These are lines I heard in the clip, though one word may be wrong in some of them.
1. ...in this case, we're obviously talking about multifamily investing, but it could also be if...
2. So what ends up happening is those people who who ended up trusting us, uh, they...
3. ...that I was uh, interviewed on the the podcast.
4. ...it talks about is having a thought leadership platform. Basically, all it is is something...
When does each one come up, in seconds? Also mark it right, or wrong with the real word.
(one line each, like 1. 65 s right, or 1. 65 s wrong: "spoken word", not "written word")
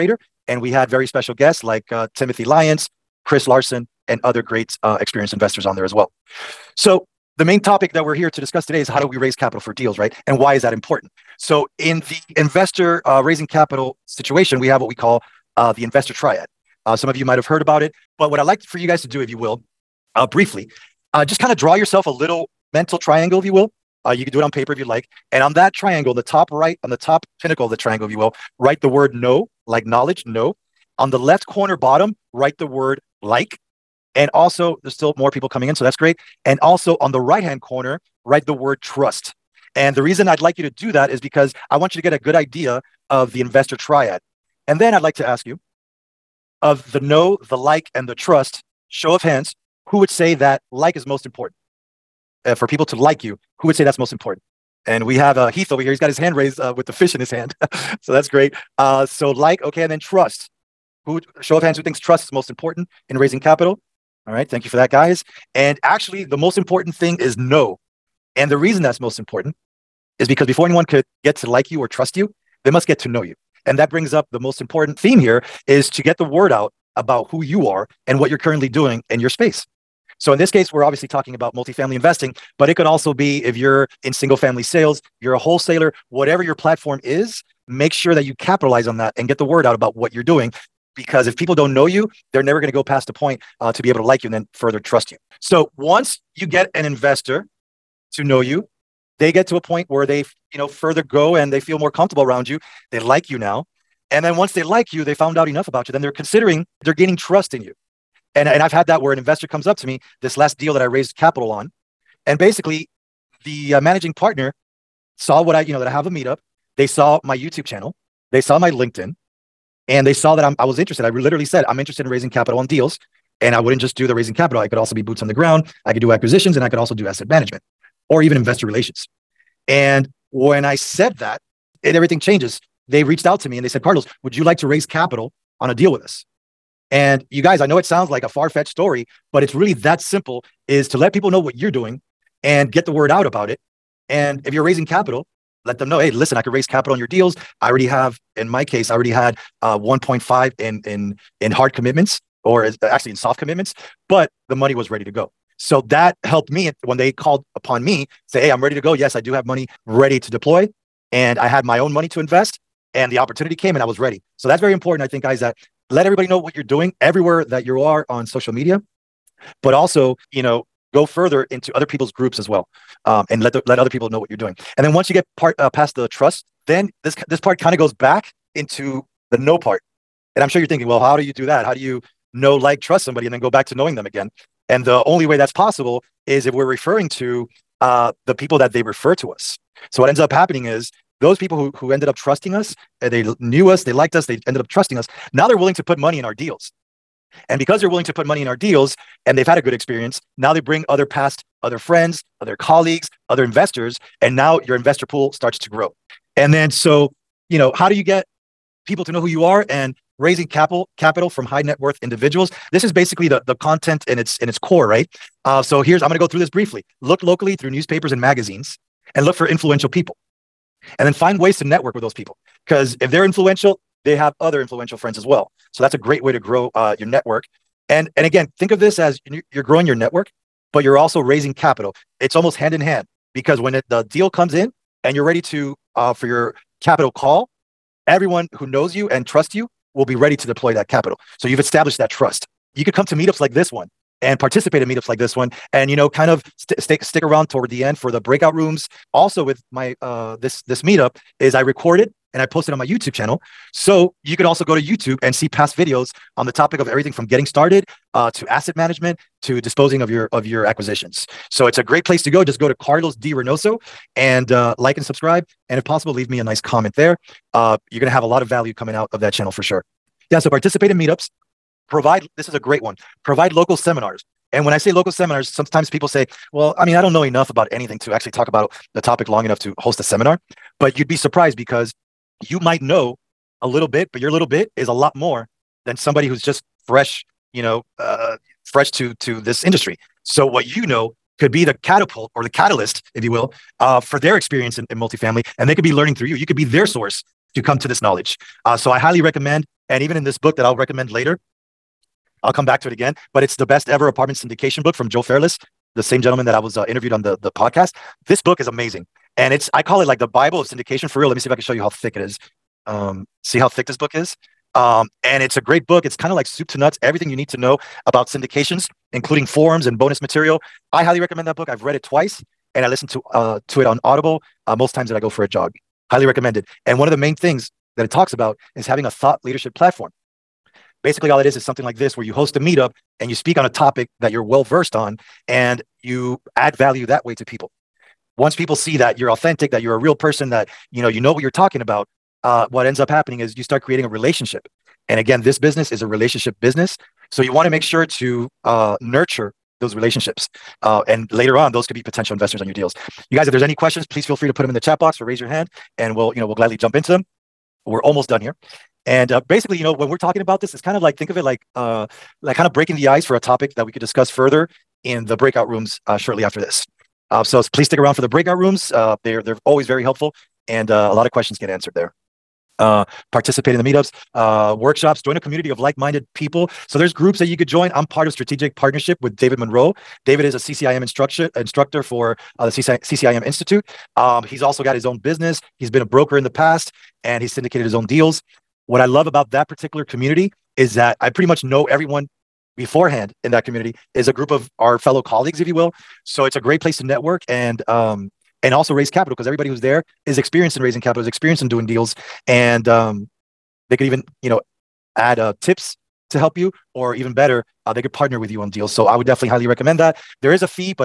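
1. 80 s right
2. 189 s right
3. 306 s right
4. 328 s right.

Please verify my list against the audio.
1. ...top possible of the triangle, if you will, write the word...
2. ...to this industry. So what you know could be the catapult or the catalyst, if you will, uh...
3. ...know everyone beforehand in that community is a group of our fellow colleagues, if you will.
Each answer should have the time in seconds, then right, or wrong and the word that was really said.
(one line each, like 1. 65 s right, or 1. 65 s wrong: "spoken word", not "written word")
1. 26 s wrong: "pinnacle", not "possible"
2. 289 s right
3. 391 s right.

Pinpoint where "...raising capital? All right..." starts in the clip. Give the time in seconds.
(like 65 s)
63 s.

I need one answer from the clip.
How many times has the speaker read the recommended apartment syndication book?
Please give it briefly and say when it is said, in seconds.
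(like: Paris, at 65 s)
Twice, at 322 s.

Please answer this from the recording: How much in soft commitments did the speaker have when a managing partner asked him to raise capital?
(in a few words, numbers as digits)
1.5.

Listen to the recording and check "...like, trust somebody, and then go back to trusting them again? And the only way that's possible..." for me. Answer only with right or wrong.
wrong.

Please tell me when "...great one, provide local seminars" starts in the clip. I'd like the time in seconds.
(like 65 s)
272 s.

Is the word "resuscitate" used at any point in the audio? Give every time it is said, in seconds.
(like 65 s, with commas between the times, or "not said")
not said.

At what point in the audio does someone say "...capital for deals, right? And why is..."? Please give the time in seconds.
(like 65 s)
9 s.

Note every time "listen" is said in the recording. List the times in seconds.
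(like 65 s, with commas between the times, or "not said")
146 s, 322 s.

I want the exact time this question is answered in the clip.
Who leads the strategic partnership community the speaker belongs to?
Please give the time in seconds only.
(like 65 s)
379 s.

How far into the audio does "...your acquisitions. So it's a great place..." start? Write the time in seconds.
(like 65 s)
260 s.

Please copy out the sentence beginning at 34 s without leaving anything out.
And also, there's still more people coming in, so that's great.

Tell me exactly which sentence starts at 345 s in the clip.
And again, this business is a relationship business.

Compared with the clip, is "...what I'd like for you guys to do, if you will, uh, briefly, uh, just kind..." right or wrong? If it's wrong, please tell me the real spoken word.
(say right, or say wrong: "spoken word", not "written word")
right.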